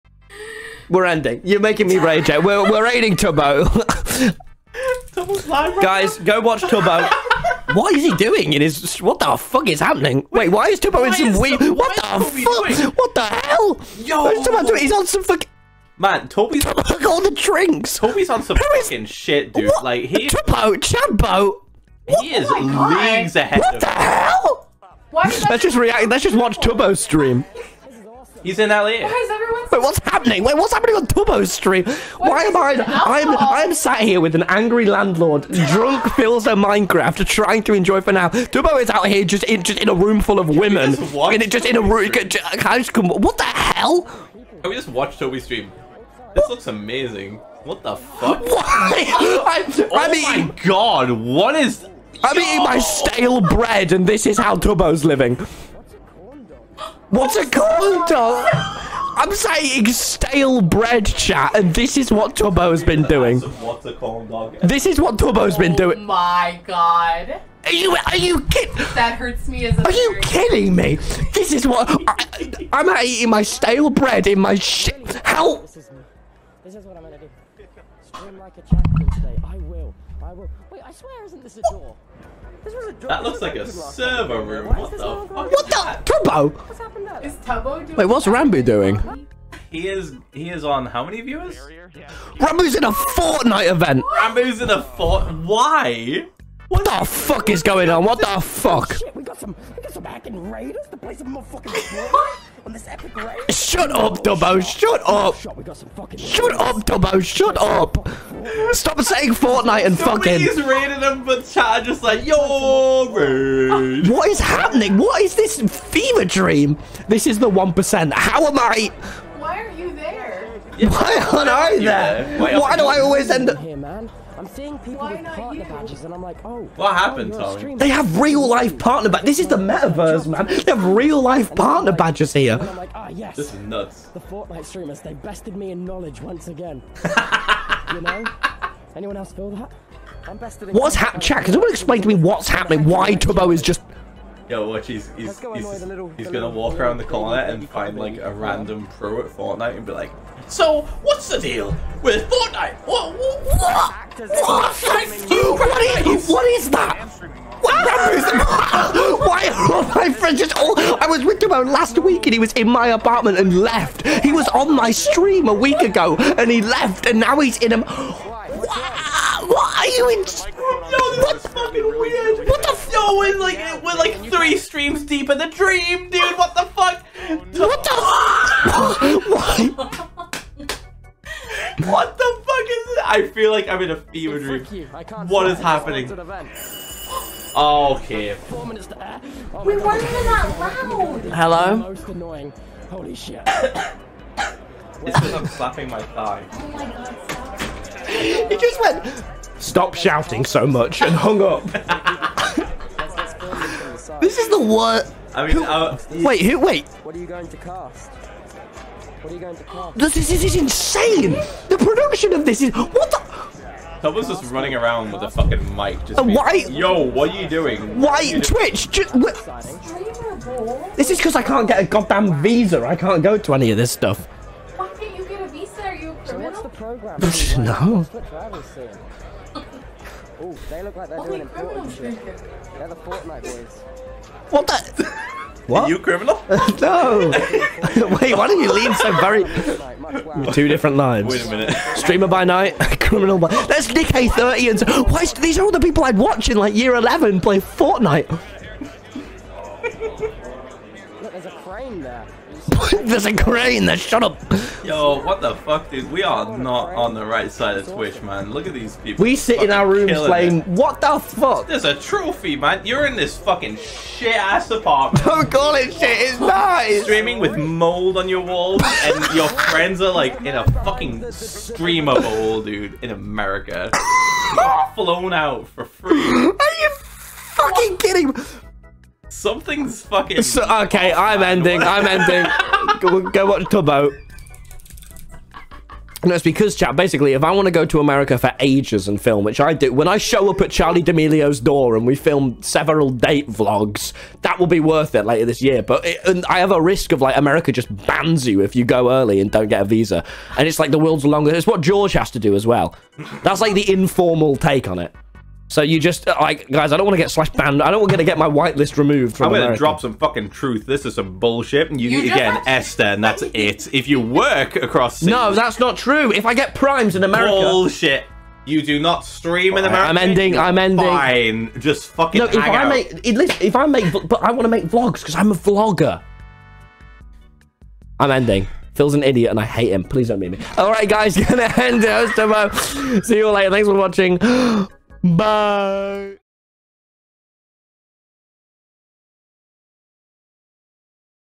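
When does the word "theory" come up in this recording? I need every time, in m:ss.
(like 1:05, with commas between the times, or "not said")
not said.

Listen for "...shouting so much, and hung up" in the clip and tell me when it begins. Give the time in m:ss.
3:19.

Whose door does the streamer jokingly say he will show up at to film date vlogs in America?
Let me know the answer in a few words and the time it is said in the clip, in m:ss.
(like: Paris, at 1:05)
Charli D'Amelio, at 4:50.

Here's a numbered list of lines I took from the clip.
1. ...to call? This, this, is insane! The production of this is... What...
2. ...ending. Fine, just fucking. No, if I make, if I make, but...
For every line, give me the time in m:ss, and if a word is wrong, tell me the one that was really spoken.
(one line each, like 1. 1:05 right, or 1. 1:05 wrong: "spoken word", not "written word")
1. 3:29 right
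2. 5:20 right.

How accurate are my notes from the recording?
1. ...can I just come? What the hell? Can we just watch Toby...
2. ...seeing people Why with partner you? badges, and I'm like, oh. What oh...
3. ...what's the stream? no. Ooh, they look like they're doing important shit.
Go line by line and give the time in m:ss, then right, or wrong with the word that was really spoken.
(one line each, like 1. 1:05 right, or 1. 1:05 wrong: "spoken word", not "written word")
1. 0:42 right
2. 2:04 right
3. 3:46 wrong: "program", not "stream".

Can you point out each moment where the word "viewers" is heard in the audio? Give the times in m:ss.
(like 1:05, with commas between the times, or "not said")
1:31.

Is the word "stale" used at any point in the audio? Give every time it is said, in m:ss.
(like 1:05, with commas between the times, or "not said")
0:52, 0:59, 1:13.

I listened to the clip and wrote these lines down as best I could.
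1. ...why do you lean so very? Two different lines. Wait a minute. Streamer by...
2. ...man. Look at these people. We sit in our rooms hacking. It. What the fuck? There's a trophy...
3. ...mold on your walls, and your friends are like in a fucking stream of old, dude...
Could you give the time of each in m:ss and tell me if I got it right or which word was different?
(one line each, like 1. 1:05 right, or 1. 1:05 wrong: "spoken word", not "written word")
1. 3:58 right
2. 4:18 wrong: "playing", not "hacking"
3. 4:27 right.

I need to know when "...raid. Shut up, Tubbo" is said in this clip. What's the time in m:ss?
1:43.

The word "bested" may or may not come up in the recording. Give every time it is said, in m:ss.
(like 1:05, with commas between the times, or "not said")
2:15, 2:20.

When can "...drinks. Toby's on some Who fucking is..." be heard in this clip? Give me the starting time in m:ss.
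0:17.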